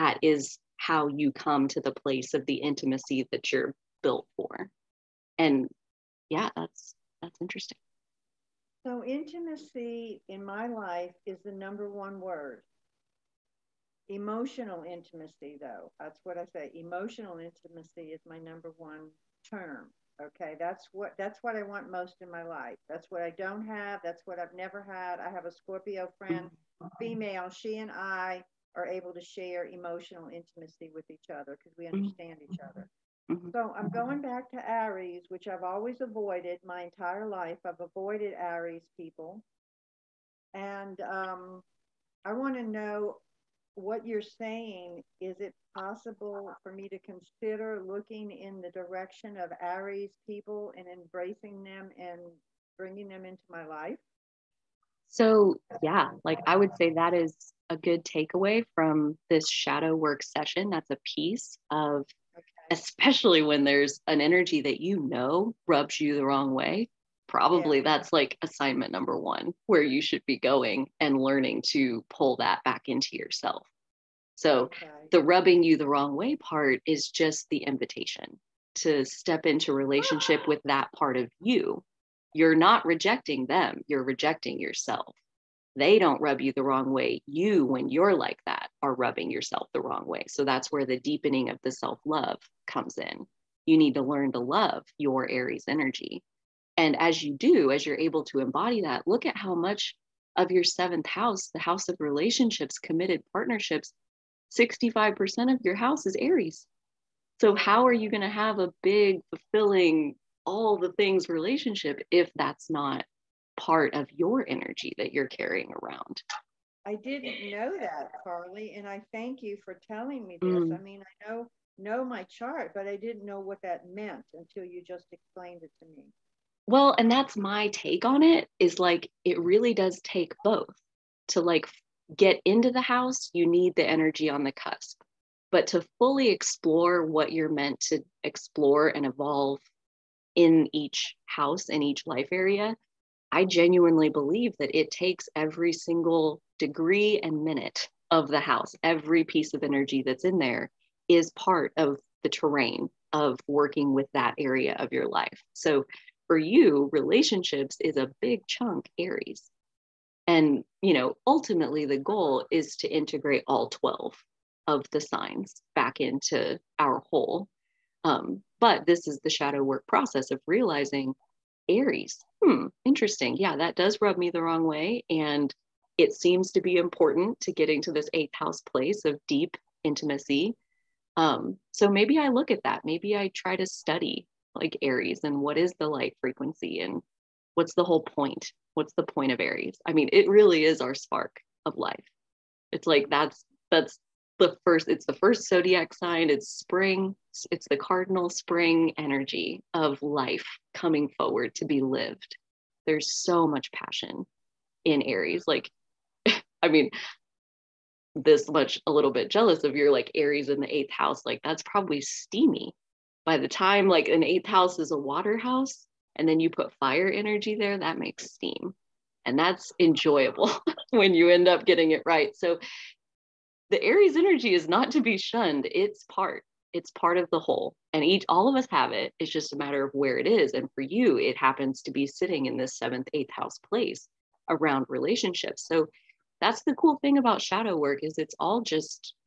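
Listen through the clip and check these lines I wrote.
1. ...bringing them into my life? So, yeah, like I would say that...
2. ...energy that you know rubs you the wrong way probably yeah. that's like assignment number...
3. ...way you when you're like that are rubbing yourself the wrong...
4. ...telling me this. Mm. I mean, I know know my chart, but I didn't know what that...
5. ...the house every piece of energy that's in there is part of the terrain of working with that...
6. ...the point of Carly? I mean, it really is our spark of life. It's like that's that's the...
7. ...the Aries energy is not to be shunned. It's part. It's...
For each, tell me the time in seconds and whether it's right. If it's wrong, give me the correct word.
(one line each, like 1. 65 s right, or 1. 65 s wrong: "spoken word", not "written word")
1. 52 s right
2. 64 s right
3. 86 s right
4. 119 s right
5. 148 s right
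6. 188 s wrong: "Aries", not "Carly"
7. 223 s right.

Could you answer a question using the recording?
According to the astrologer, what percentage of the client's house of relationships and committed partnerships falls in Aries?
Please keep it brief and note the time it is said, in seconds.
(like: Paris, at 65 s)
65%, at 104 s.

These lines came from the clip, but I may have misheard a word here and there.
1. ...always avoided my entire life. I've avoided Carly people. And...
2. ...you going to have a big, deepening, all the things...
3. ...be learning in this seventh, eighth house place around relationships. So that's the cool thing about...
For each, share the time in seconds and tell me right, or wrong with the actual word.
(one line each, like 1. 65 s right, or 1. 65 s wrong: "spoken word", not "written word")
1. 35 s wrong: "Aries", not "Carly"
2. 107 s wrong: "fulfilling", not "deepening"
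3. 231 s wrong: "sitting", not "learning".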